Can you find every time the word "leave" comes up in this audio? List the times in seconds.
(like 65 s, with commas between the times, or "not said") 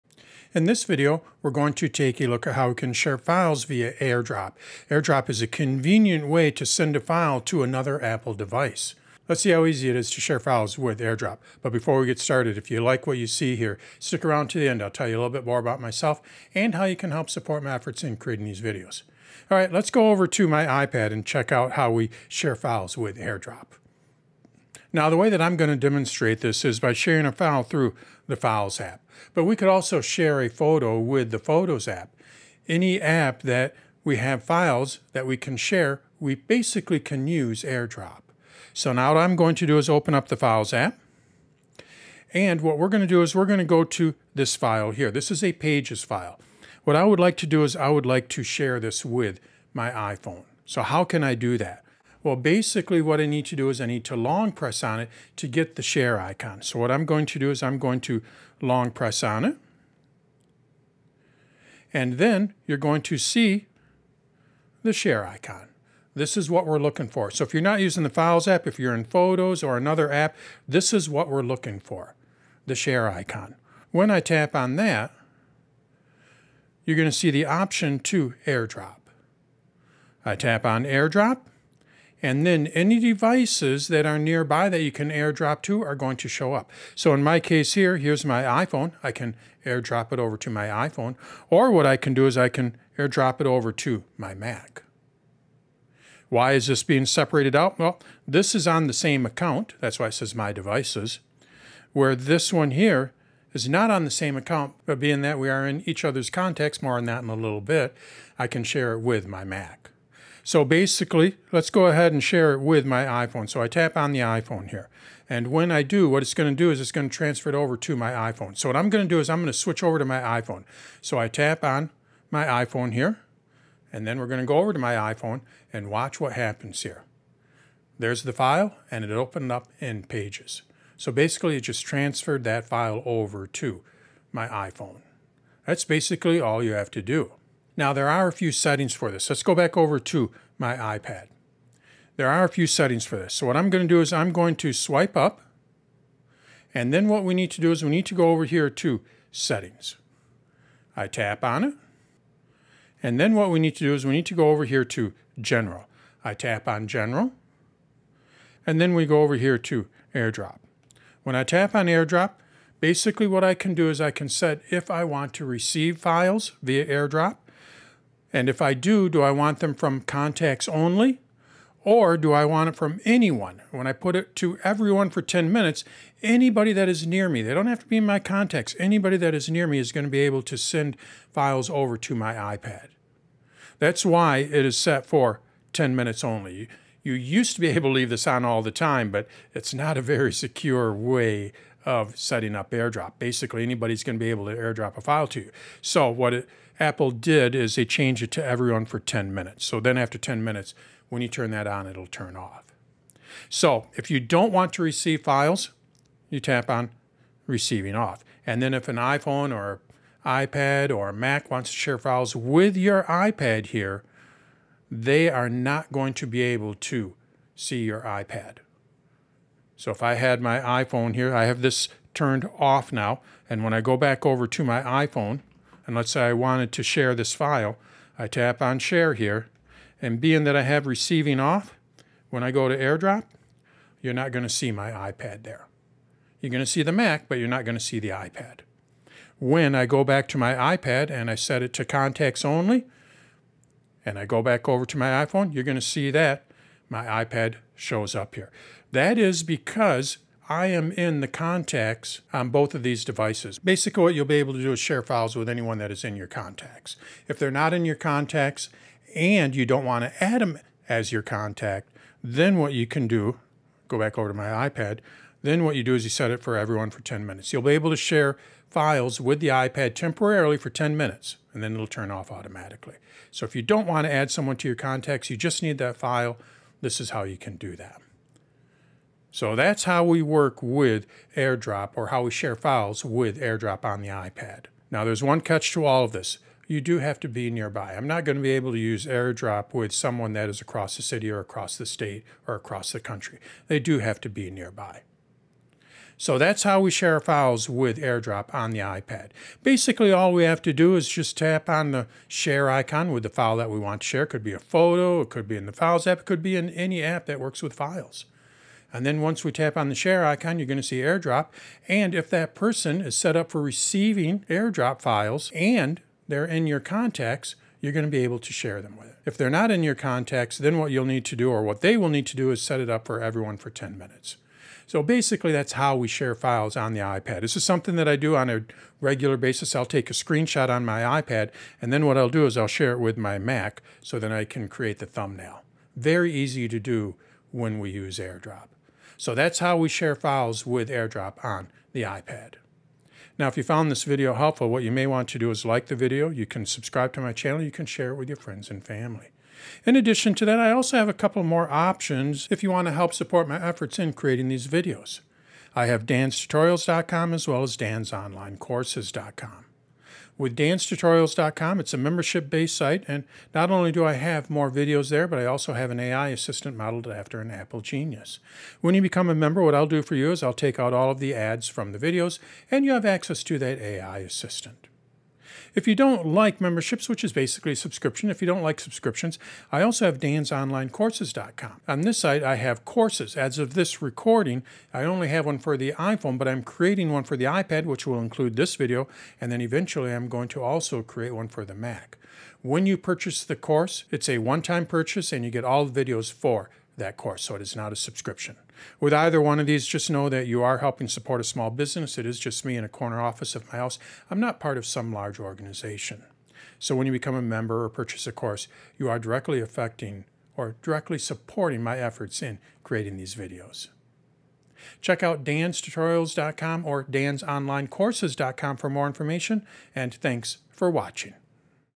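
187 s.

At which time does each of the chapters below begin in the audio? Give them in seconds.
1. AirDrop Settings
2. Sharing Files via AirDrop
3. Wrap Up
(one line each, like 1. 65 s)
1. 128 s
2. 15 s
3. 286 s.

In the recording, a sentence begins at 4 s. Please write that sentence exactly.
AirDrop is a convenient way to send a file to another Apple device.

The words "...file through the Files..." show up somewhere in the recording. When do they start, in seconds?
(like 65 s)
27 s.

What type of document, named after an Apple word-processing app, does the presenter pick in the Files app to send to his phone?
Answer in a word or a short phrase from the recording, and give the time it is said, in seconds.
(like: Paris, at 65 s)
Pages file, at 45 s.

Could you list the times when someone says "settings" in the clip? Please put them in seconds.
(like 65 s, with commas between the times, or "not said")
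138 s, 142 s, 149 s, 192 s.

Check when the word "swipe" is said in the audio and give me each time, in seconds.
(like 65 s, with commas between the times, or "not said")
144 s.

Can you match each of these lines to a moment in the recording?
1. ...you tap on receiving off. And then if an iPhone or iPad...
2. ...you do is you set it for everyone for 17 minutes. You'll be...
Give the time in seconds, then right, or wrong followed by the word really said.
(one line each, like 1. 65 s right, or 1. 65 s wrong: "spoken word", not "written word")
1. 206 s right
2. 265 s wrong: "10", not "17".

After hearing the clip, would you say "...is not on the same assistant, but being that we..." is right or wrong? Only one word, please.
wrong.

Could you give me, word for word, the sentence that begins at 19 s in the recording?
All right, let's go over to my iPad and check out how we share files with AirDrop.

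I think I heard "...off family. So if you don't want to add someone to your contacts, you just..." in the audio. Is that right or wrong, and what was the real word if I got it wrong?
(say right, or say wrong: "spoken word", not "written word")
wrong: "automatically", not "family".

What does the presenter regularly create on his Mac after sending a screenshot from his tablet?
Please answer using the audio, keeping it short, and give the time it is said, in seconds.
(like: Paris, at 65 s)
The thumbnail, at 334 s.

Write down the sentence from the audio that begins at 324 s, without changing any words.
So basically, that's how we share files on the iPad.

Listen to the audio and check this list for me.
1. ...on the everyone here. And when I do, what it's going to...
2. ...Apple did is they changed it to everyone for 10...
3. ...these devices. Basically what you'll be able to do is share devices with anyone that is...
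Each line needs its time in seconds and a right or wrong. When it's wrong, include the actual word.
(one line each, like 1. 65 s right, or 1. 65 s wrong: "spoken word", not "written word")
1. 113 s wrong: "iPhone", not "everyone"
2. 196 s right
3. 252 s wrong: "files", not "devices".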